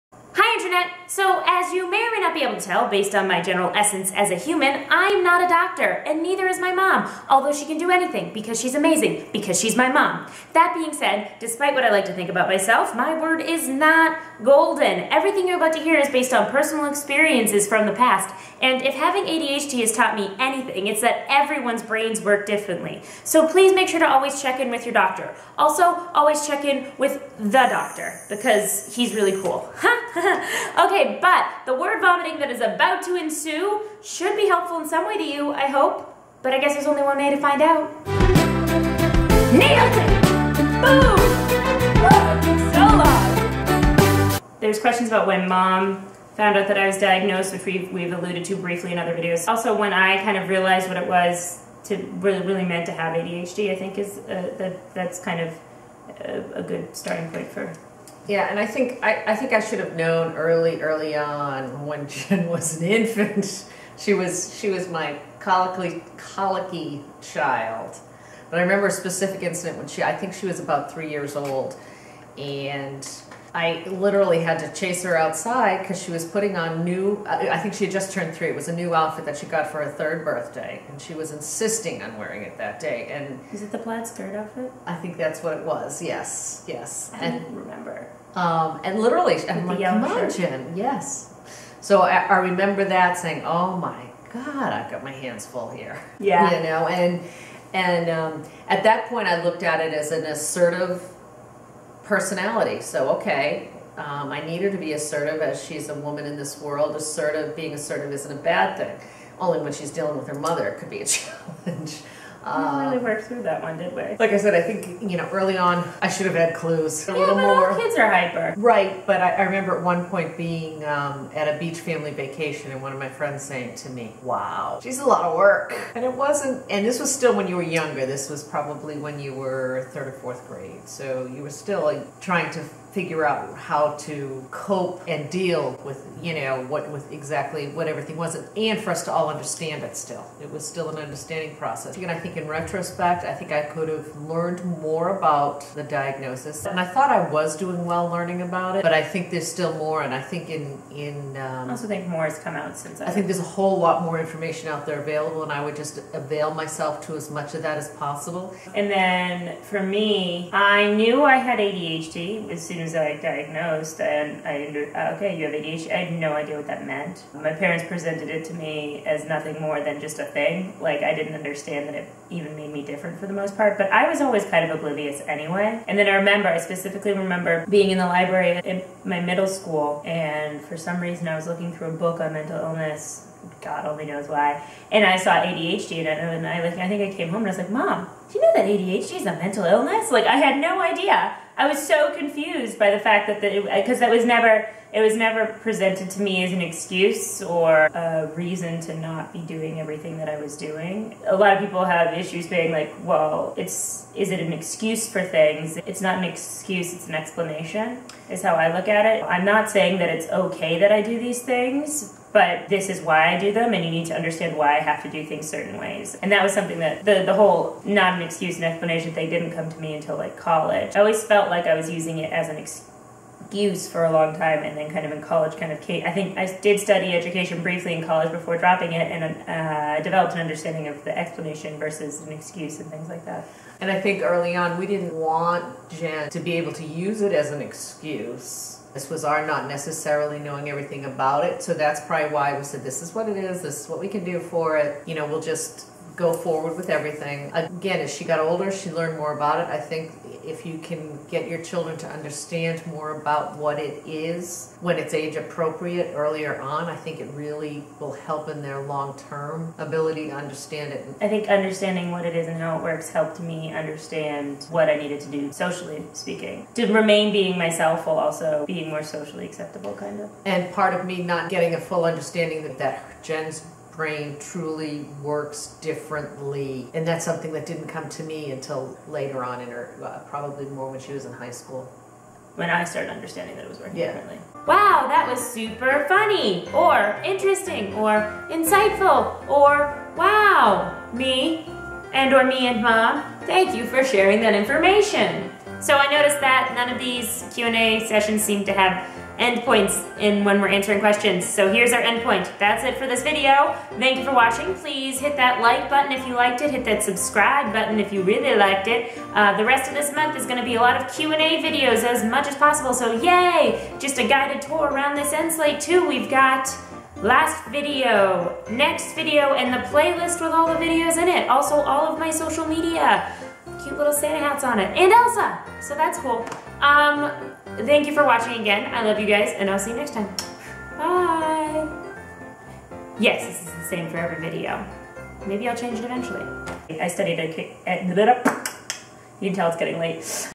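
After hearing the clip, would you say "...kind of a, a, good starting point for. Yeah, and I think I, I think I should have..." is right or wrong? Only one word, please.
right.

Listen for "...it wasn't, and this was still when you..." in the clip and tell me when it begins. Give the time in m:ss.
2:06.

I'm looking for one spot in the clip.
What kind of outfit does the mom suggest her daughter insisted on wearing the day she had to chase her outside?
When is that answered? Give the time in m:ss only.
1:23.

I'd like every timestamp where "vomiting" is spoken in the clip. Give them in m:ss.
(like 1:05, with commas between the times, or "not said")
0:32.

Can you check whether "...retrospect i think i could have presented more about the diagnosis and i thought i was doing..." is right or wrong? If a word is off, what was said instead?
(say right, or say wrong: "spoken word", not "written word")
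wrong: "learned", not "presented".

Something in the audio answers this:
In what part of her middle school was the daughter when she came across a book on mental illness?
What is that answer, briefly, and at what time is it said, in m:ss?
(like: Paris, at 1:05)
the library, at 2:58.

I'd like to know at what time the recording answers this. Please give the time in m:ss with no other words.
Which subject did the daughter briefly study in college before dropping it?
3:47.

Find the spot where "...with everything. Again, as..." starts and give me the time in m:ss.
4:06.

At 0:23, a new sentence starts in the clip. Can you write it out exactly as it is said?
So please make sure to always check in with your doctor.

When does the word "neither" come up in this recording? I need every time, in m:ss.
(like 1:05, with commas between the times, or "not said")
0:06.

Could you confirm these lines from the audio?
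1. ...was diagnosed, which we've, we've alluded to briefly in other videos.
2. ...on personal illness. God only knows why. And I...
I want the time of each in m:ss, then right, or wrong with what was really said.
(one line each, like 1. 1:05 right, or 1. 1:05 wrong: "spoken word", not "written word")
1. 0:46 right
2. 3:02 wrong: "mental", not "personal".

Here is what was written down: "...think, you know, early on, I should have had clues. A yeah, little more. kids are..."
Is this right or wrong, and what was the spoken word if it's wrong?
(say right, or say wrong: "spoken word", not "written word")
right.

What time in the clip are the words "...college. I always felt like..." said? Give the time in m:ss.
3:40.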